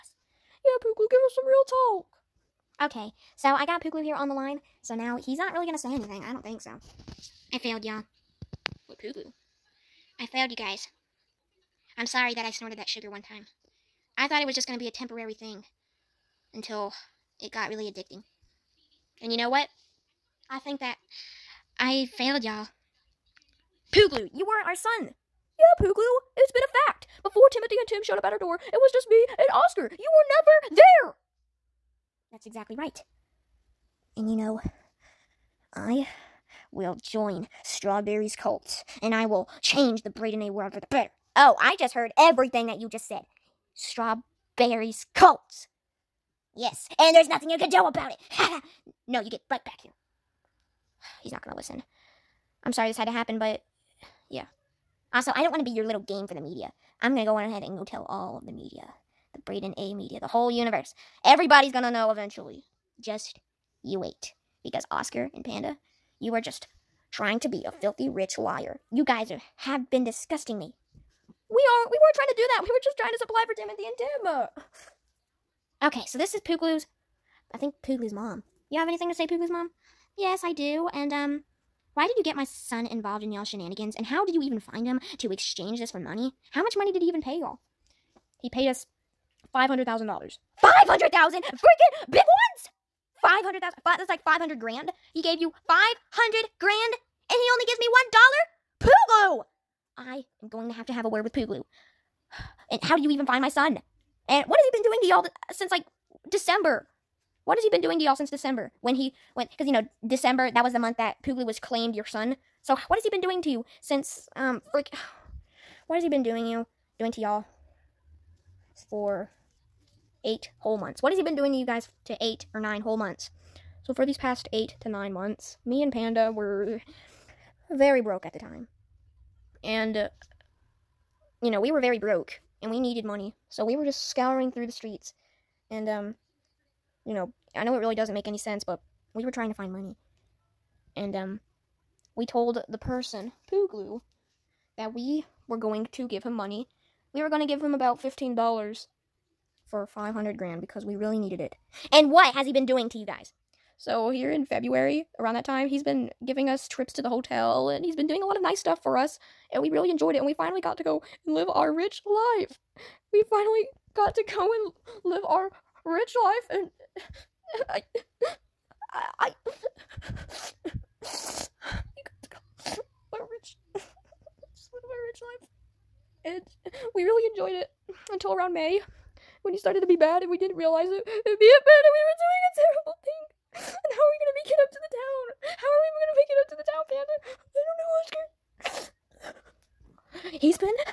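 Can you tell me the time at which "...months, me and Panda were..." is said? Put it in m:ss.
2:05.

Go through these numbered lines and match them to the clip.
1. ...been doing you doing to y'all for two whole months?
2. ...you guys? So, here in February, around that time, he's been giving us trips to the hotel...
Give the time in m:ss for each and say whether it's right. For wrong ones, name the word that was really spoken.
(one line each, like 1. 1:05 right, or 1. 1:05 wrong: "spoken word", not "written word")
1. 1:56 wrong: "eight", not "two"
2. 2:32 right.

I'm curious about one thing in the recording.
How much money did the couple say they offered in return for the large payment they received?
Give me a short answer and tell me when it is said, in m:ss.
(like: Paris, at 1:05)
$15, at 2:27.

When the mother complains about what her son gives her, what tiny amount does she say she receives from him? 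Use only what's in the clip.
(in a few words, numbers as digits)
$1.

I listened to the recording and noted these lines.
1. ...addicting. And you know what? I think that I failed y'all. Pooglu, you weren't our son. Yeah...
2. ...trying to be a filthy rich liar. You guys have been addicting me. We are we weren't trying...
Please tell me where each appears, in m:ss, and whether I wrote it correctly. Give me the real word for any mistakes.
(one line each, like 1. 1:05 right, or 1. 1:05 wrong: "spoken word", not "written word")
1. 0:17 right
2. 1:07 wrong: "disgusting", not "addicting".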